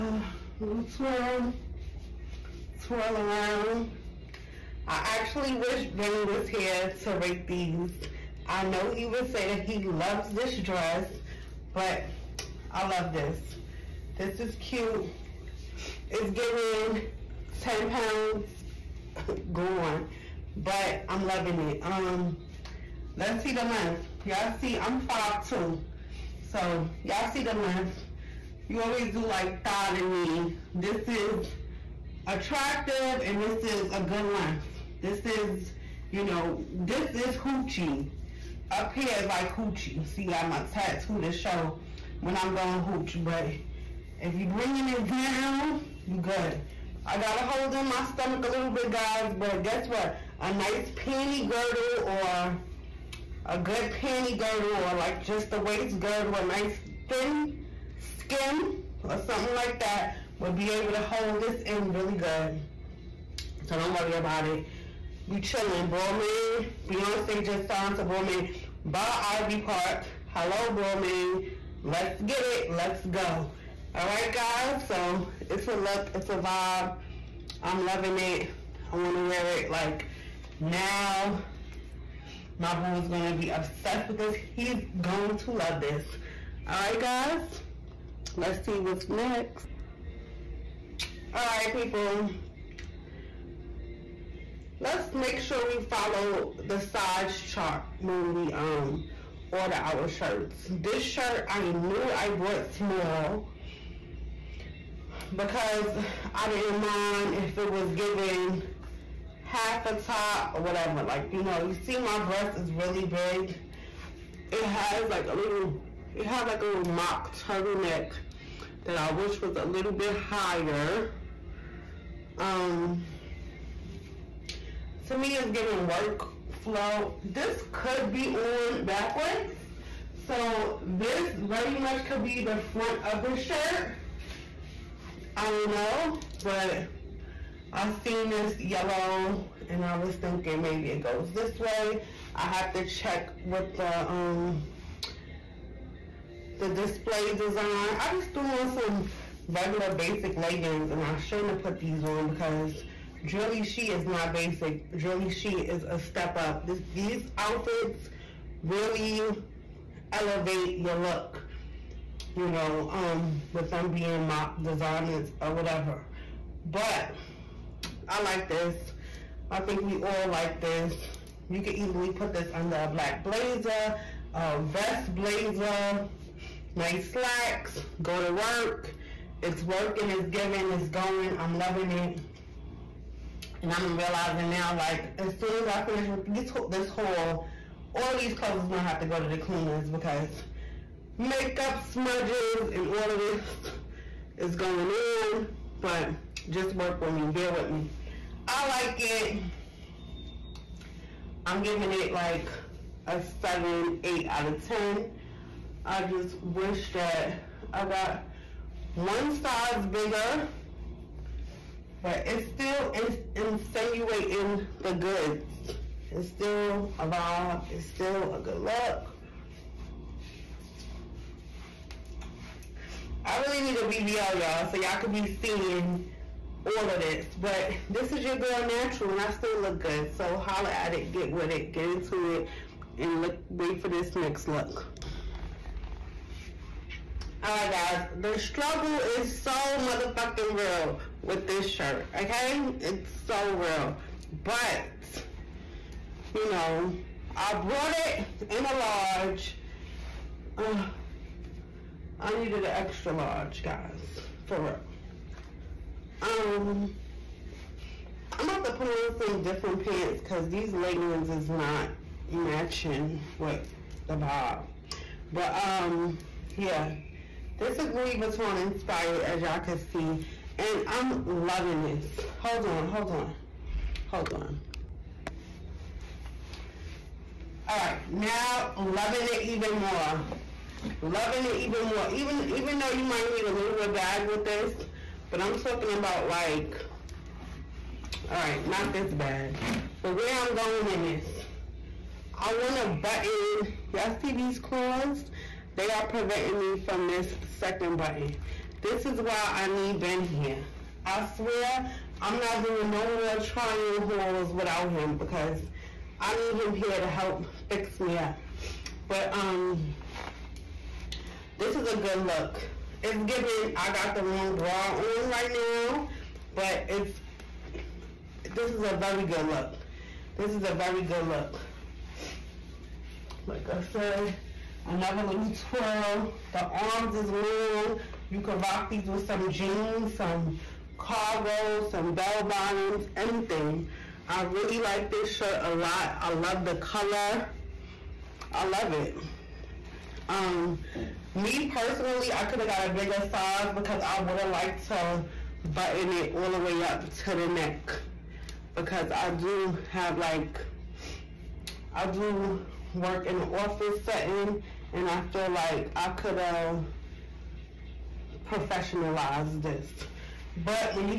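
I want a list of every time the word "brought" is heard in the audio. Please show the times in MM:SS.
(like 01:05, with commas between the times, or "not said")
01:42, 04:07.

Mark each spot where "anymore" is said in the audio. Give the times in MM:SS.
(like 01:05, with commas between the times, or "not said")
not said.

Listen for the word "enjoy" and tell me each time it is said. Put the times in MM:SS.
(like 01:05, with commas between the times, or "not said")
not said.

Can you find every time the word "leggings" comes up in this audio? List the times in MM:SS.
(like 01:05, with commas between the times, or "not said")
02:30, 04:20.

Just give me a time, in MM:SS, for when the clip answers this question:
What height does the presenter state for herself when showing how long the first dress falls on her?
00:25.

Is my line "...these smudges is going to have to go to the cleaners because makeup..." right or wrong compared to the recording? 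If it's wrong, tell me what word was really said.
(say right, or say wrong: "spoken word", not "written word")
wrong: "clothes", not "smudges".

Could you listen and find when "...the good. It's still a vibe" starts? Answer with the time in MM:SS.
03:34.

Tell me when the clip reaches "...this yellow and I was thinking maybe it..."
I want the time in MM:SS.
02:18.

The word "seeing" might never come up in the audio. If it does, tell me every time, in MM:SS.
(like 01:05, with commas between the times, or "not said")
03:45.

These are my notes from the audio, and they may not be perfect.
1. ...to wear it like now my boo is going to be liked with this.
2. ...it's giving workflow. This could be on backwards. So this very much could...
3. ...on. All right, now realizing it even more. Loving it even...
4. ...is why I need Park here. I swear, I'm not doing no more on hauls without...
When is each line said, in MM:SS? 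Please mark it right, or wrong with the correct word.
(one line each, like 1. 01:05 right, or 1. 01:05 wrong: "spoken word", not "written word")
1. 01:19 wrong: "obsessed", not "liked"
2. 02:05 right
3. 04:34 wrong: "loving", not "realizing"
4. 04:59 wrong: "Ben", not "Park".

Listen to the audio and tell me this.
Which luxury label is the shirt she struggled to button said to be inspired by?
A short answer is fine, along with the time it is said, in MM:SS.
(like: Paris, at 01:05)
Louis Vuitton, at 04:27.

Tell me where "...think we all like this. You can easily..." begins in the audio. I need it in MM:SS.
02:49.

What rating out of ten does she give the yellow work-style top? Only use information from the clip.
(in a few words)
7, 8.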